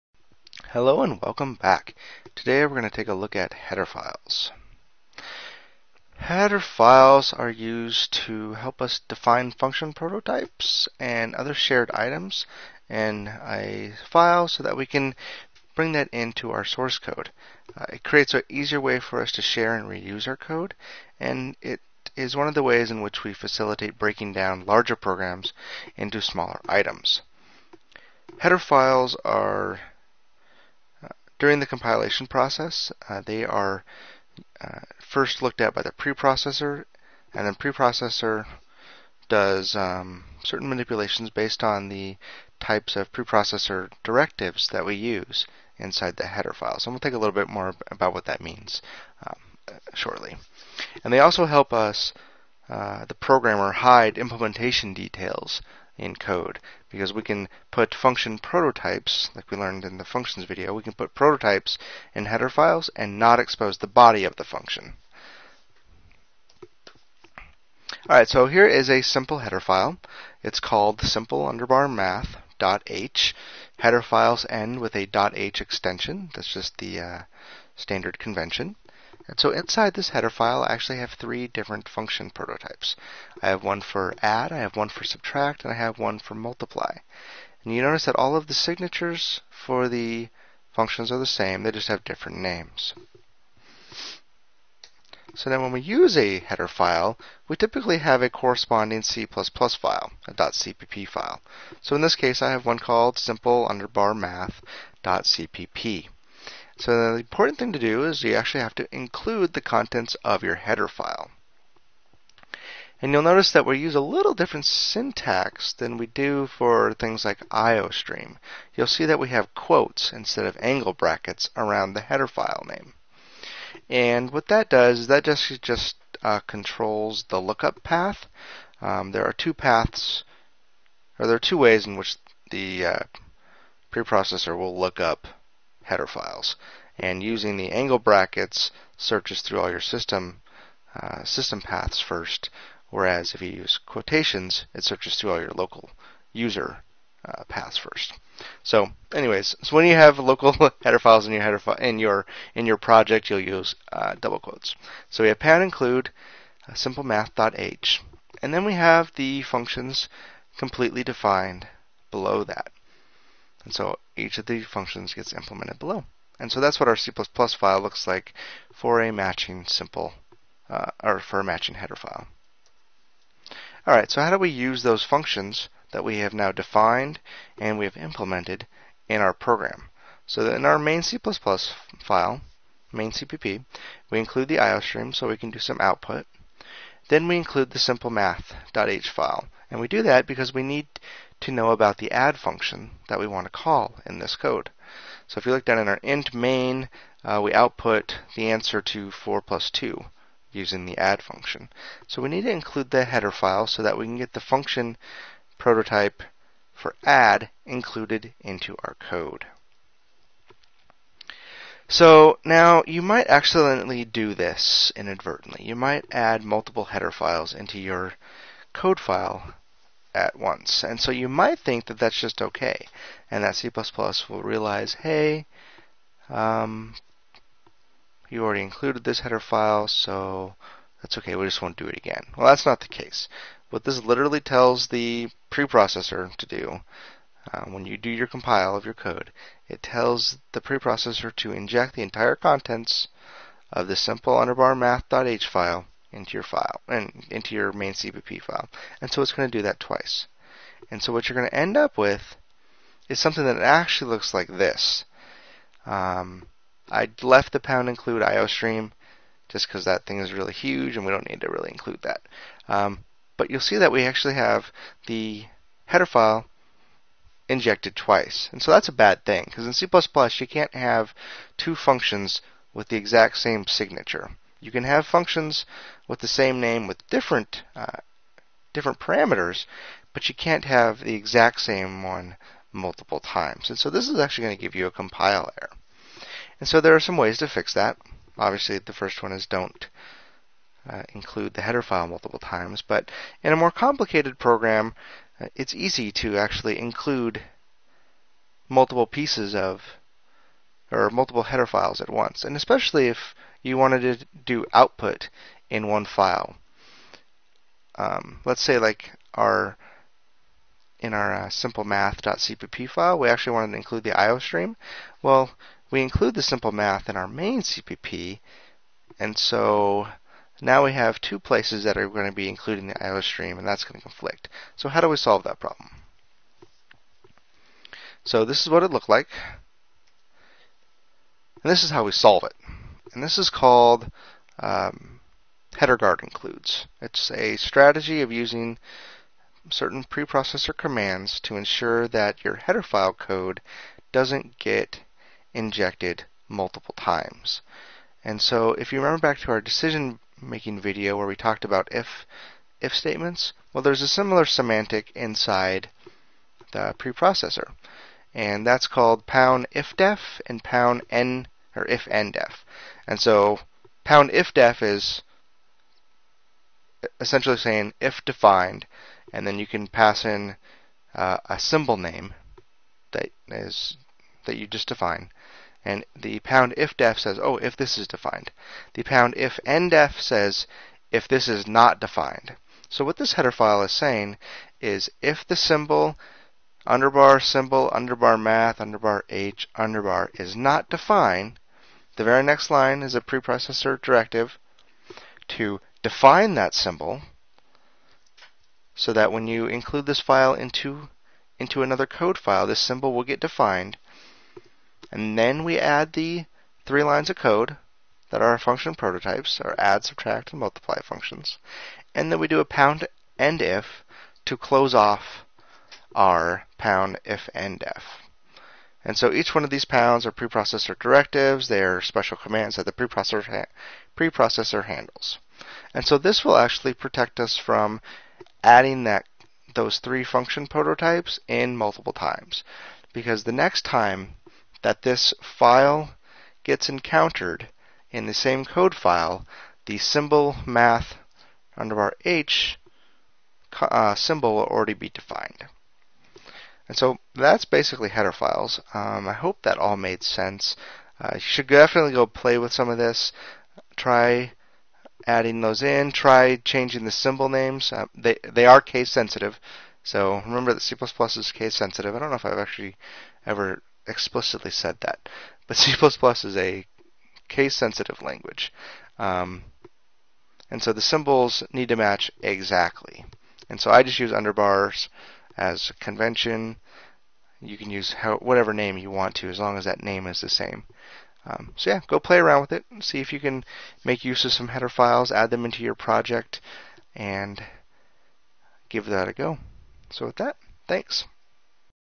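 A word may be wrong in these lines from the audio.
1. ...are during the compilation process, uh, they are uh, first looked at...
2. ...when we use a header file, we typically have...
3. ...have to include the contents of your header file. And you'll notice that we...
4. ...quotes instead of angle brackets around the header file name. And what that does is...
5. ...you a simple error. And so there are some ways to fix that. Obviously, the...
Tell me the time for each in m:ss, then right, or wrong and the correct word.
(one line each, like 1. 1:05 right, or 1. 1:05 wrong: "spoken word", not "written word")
1. 0:29 right
2. 1:35 right
3. 1:48 right
4. 1:59 right
5. 4:44 wrong: "compile", not "simple".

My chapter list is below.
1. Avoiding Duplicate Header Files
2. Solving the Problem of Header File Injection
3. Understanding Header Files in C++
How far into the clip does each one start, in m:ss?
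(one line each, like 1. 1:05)
1. 2:04
2. 4:16
3. 6:28.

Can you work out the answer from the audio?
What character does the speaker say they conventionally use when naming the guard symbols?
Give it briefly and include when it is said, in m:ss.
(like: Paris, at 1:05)
Underbars, at 7:54.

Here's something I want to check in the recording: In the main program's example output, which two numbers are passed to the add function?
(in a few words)
4 and 2.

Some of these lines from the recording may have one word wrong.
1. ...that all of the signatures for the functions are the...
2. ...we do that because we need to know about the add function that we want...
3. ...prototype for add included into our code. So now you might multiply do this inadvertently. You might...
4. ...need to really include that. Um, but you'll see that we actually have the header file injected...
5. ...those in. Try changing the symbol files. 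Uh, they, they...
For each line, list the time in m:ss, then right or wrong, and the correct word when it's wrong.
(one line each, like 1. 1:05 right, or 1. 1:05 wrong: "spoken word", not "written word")
1. 1:28 right
2. 3:09 right
3. 3:25 wrong: "accidentally", not "multiply"
4. 4:21 right
5. 7:35 wrong: "names", not "files".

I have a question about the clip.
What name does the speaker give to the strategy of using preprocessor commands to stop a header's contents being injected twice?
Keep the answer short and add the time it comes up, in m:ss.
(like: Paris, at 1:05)
Header guard includes, at 5:35.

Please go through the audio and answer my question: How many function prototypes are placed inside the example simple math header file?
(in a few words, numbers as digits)
3.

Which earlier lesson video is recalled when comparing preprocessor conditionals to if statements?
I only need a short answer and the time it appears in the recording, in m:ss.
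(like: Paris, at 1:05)
Decision making video, at 5:49.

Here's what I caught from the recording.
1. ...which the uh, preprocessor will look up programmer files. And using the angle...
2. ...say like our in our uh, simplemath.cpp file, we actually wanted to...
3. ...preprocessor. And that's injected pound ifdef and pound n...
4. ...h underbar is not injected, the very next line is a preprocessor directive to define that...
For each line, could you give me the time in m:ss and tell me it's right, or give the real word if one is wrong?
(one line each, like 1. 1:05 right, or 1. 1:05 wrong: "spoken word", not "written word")
1. 2:11 wrong: "header", not "programmer"
2. 5:08 right
3. 5:56 wrong: "called", not "injected"
4. 6:29 wrong: "defined", not "injected".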